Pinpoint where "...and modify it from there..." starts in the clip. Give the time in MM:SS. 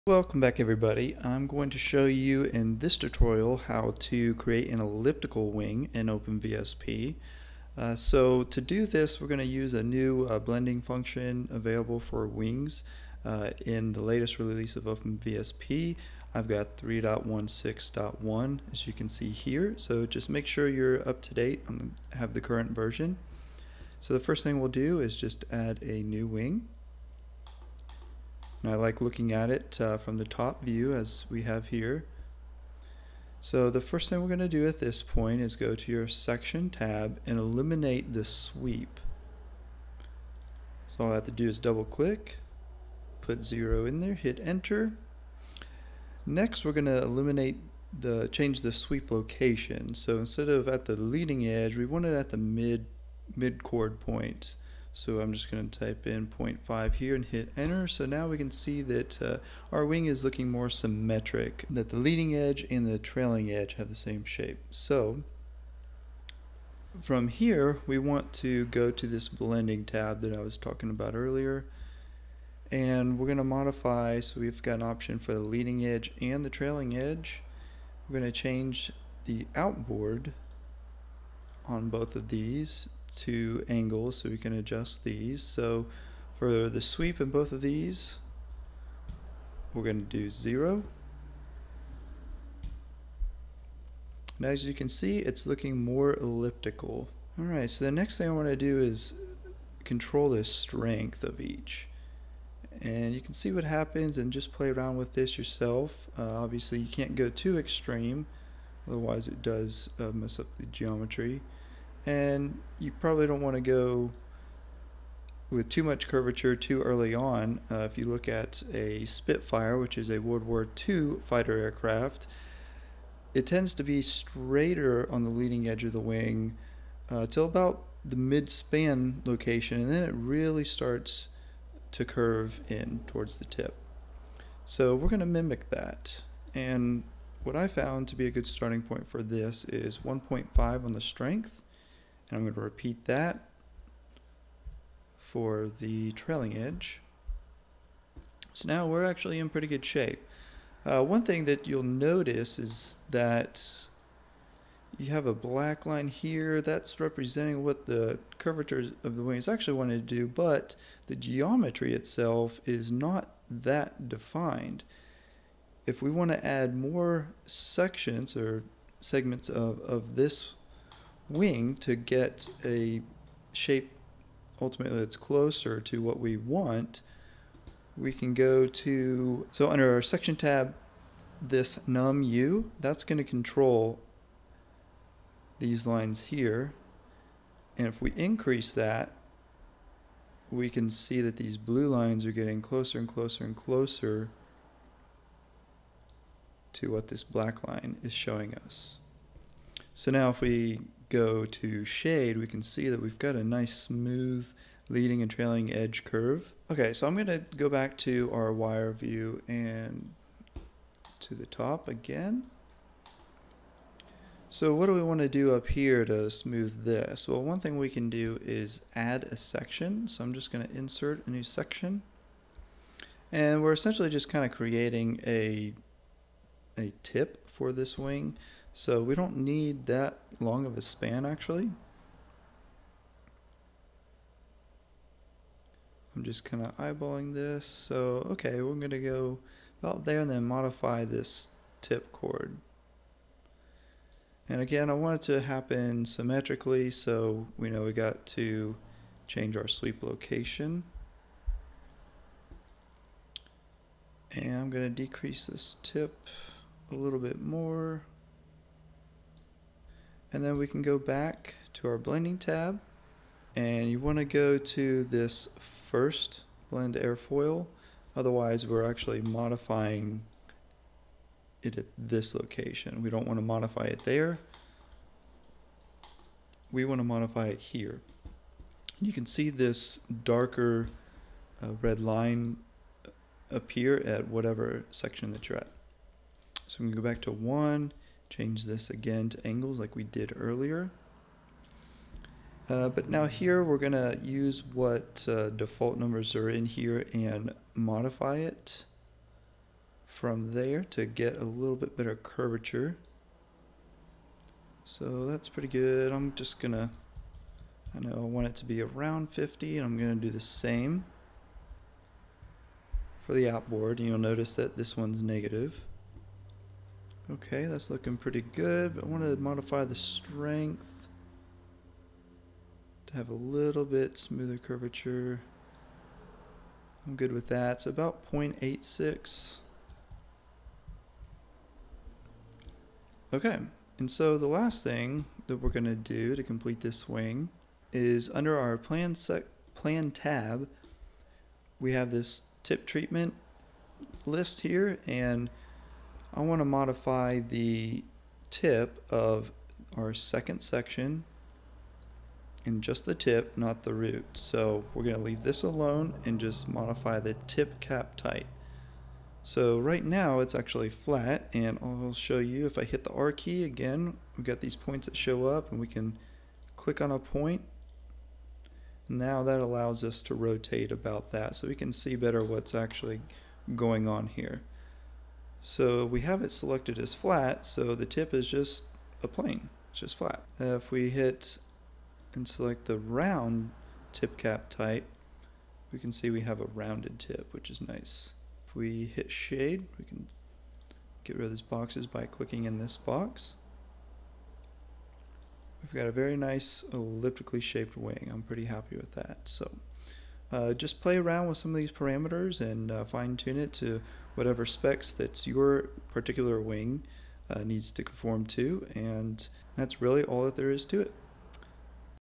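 04:57.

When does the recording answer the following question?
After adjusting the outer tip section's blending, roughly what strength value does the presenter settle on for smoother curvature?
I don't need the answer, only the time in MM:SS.
05:28.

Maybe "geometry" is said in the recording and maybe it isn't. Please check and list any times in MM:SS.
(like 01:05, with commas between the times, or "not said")
01:50, 02:41.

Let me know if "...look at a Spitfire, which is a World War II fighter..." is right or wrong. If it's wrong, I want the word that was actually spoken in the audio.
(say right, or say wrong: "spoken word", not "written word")
right.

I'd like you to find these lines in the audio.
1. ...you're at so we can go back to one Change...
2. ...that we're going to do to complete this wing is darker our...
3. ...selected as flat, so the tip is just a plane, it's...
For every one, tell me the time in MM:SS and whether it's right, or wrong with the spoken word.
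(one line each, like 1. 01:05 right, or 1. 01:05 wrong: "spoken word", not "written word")
1. 04:45 right
2. 05:35 wrong: "under", not "darker"
3. 06:16 right.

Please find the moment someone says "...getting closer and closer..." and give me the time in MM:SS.
03:12.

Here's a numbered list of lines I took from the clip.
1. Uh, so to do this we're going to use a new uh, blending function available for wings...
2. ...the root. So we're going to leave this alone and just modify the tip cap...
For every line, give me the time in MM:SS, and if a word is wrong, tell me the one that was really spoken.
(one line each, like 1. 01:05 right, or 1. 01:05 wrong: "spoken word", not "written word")
1. 00:07 right
2. 05:53 right.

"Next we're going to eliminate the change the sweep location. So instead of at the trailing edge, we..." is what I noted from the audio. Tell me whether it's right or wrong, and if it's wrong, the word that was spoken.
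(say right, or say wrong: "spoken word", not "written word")
wrong: "leading", not "trailing".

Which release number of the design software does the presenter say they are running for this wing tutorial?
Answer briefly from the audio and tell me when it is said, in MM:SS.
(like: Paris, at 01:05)
3.16.1, at 00:16.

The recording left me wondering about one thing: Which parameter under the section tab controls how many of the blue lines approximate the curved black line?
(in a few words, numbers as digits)
num u.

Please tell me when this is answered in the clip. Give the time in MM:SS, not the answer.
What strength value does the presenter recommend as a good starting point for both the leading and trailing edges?
02:19.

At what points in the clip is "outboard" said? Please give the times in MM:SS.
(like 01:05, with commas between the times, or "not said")
01:19, 05:13.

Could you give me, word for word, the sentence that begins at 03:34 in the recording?
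So what do we want to do up here to smooth this?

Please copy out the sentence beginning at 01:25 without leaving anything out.
So for the sweep in both of these, we're going to do 0.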